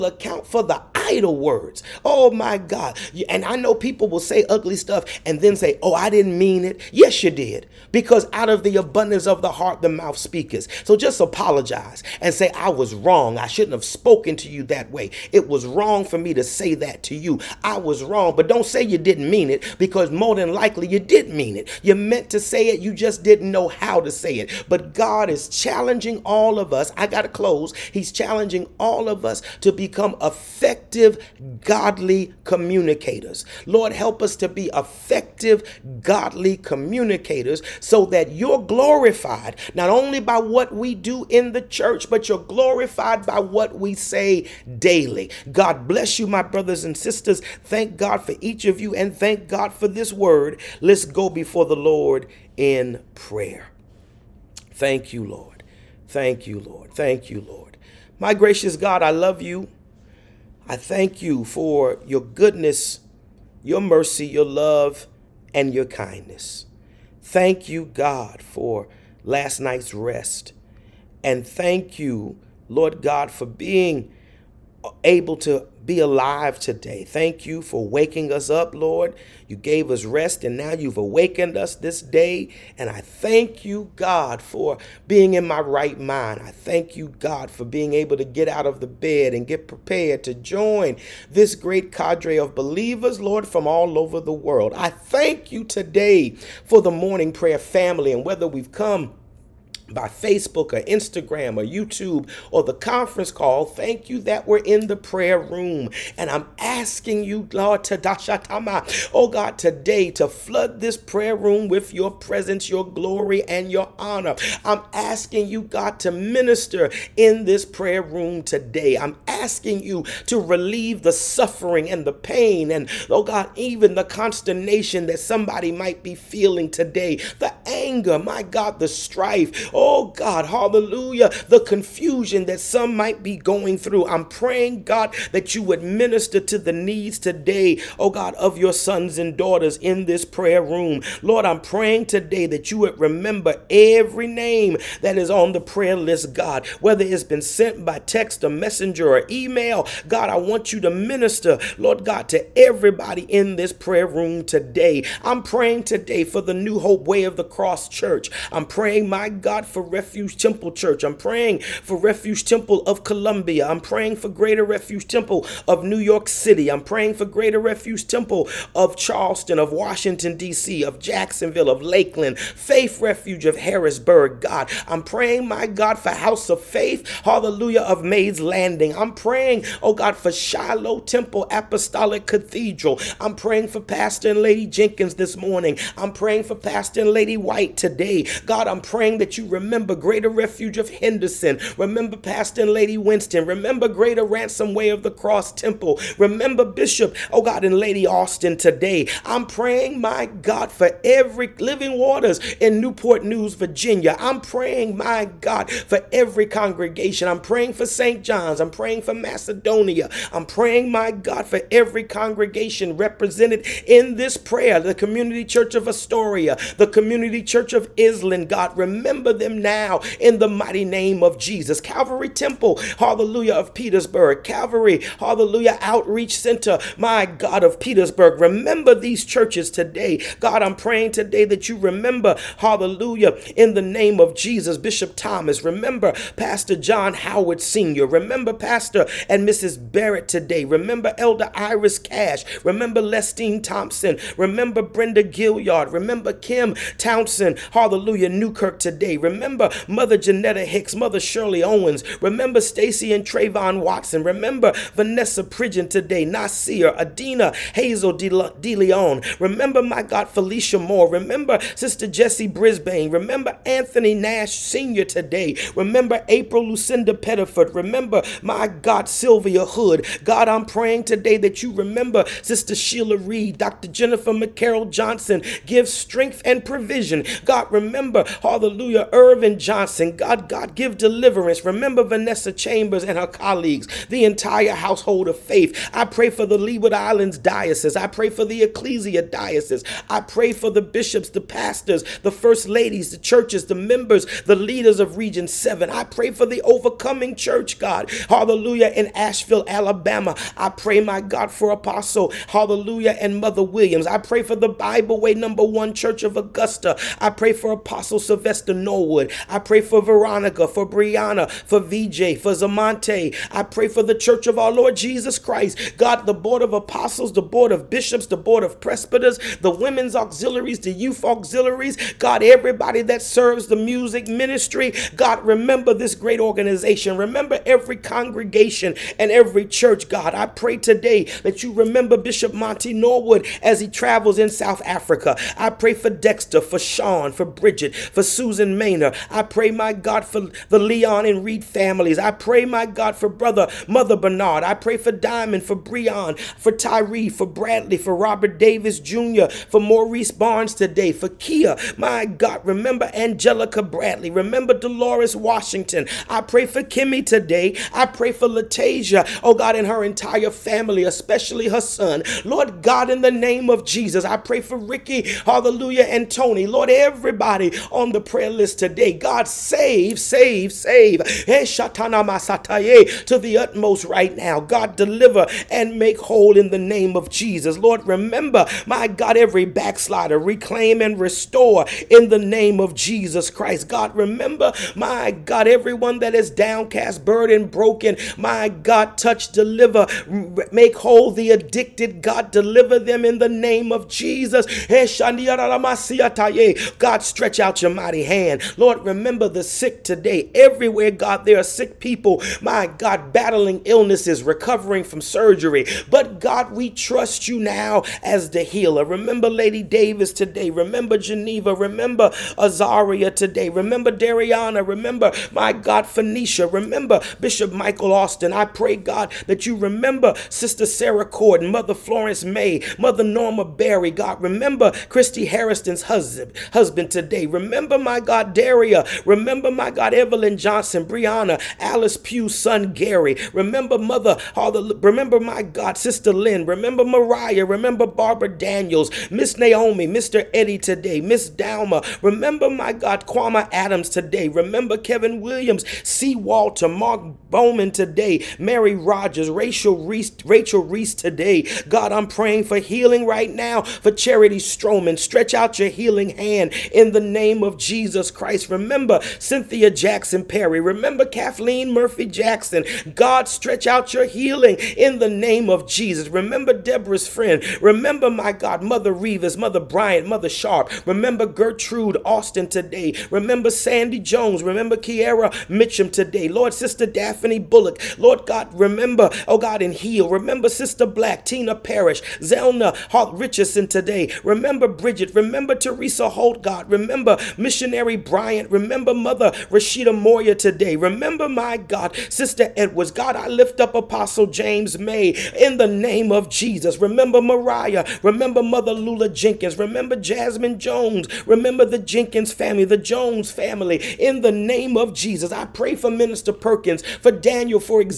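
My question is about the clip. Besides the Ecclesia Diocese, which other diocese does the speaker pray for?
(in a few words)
Leeward Islands.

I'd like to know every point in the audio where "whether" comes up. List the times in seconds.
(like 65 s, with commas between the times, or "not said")
98 s, 146 s.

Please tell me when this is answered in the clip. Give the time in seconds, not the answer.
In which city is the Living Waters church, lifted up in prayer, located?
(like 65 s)
202 s.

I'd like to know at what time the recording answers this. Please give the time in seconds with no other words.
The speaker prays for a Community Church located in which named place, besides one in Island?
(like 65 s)
215 s.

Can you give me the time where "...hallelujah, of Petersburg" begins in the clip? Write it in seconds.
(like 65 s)
222 s.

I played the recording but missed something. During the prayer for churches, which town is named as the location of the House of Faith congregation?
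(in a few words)
Mays Landing.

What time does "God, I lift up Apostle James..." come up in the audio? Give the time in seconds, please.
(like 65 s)
493 s.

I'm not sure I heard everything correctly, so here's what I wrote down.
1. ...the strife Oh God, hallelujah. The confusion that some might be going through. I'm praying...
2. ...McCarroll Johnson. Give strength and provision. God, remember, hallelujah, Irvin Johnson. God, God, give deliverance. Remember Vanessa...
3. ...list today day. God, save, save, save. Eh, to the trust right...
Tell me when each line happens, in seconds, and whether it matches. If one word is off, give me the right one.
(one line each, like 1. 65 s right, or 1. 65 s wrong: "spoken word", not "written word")
1. 128 s right
2. 274 s right
3. 368 s wrong: "utmost", not "trust".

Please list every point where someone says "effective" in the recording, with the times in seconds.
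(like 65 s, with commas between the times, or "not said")
30 s, 34 s.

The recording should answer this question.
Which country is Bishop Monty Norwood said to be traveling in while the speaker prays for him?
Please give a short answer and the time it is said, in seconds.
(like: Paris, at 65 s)
South Africa, at 334 s.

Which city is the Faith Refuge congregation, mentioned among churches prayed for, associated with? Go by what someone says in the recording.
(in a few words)
Harrisburg.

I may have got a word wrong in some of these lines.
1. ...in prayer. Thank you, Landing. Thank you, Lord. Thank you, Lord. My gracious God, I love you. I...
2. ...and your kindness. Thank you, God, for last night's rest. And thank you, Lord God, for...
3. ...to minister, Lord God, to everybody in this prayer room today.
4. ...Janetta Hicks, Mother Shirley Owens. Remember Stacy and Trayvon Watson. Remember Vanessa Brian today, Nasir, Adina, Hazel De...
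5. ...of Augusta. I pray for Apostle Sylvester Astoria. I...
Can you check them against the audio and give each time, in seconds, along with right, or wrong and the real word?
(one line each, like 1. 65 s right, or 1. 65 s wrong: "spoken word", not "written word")
1. 52 s wrong: "Lord", not "Landing"
2. 65 s right
3. 150 s right
4. 250 s wrong: "Pridgeon", not "Brian"
5. 306 s wrong: "Norwood", not "Astoria".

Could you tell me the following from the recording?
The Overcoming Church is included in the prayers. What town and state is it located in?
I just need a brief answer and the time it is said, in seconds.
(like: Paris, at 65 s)
Ashville, Alabama, at 299 s.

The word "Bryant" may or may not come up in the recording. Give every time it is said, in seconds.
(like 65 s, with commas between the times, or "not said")
469 s, 488 s.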